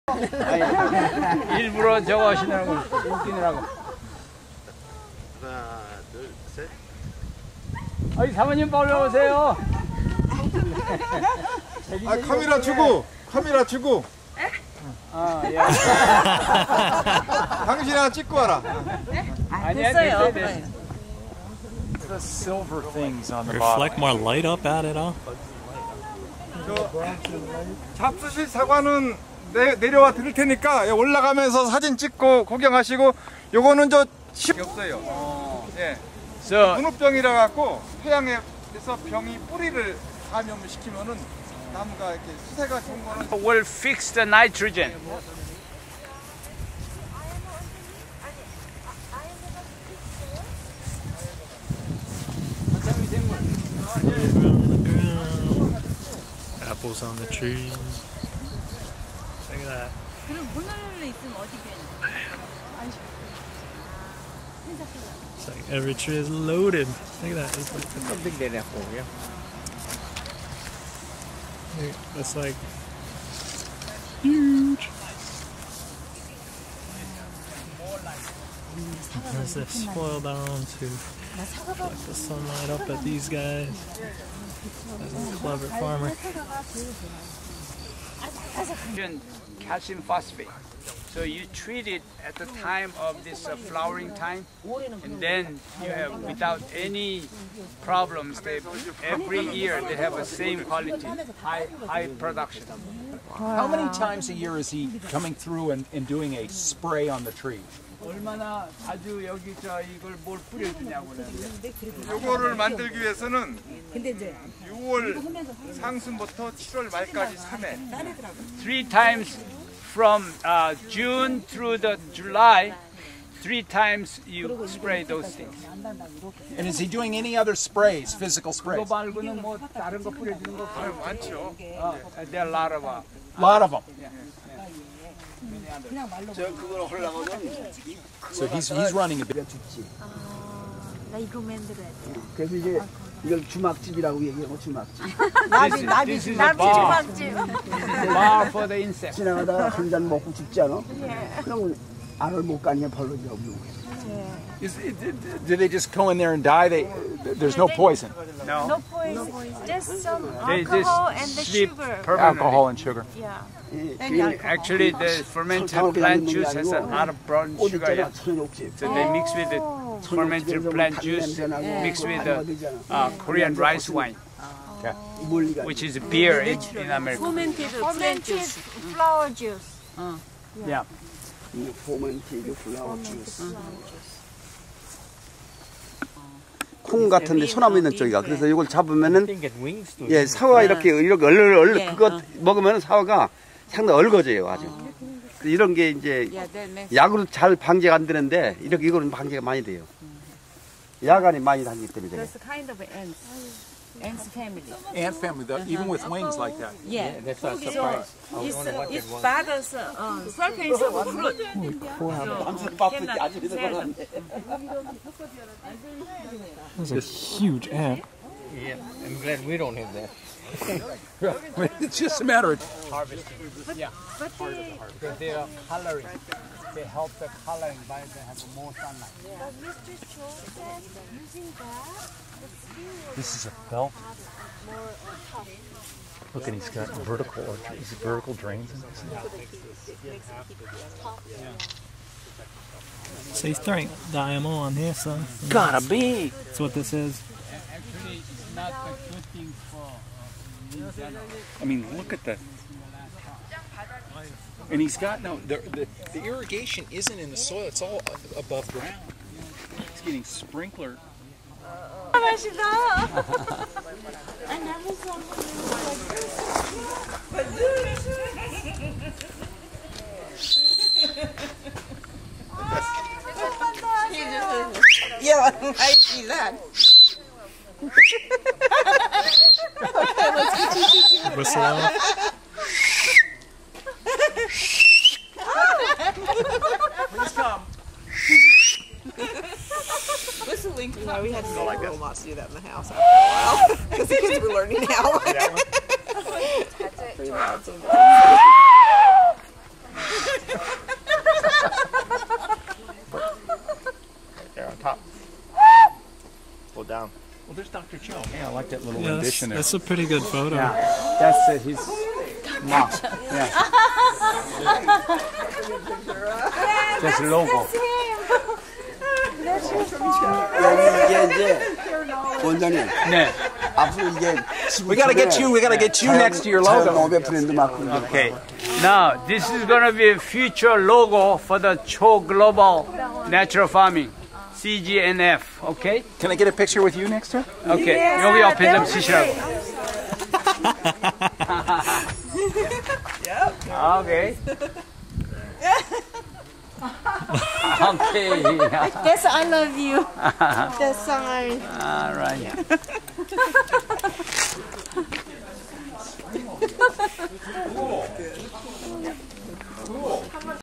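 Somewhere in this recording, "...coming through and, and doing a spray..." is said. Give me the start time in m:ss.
1:45.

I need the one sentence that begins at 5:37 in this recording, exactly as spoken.
Okay, yeah, 여기 옆에 좀 쓰시라고.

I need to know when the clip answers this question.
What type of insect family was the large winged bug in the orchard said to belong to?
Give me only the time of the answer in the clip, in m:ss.
3:24.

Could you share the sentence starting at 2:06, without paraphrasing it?
And is he doing any other sprays, physical sprays?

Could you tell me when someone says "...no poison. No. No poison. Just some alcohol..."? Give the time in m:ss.
2:37.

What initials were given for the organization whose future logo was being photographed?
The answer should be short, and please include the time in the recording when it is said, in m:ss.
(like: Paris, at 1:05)
CGNF, at 5:34.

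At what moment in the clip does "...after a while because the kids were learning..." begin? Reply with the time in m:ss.
4:52.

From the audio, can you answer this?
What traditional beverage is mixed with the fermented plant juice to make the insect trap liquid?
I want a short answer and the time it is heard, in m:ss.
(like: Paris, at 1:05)
Korean rice wine, at 2:53.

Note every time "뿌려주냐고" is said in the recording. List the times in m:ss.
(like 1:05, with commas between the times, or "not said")
1:50.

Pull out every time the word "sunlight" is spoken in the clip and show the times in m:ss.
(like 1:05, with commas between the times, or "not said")
1:22, 3:48.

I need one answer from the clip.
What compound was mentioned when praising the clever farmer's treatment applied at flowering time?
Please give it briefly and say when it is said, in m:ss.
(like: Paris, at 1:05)
Calcium phosphate, at 1:29.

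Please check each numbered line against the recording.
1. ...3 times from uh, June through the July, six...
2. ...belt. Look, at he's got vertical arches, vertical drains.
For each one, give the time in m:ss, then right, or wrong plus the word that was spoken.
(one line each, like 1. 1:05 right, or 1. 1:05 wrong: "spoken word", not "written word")
1. 1:57 wrong: "three", not "six"
2. 3:53 right.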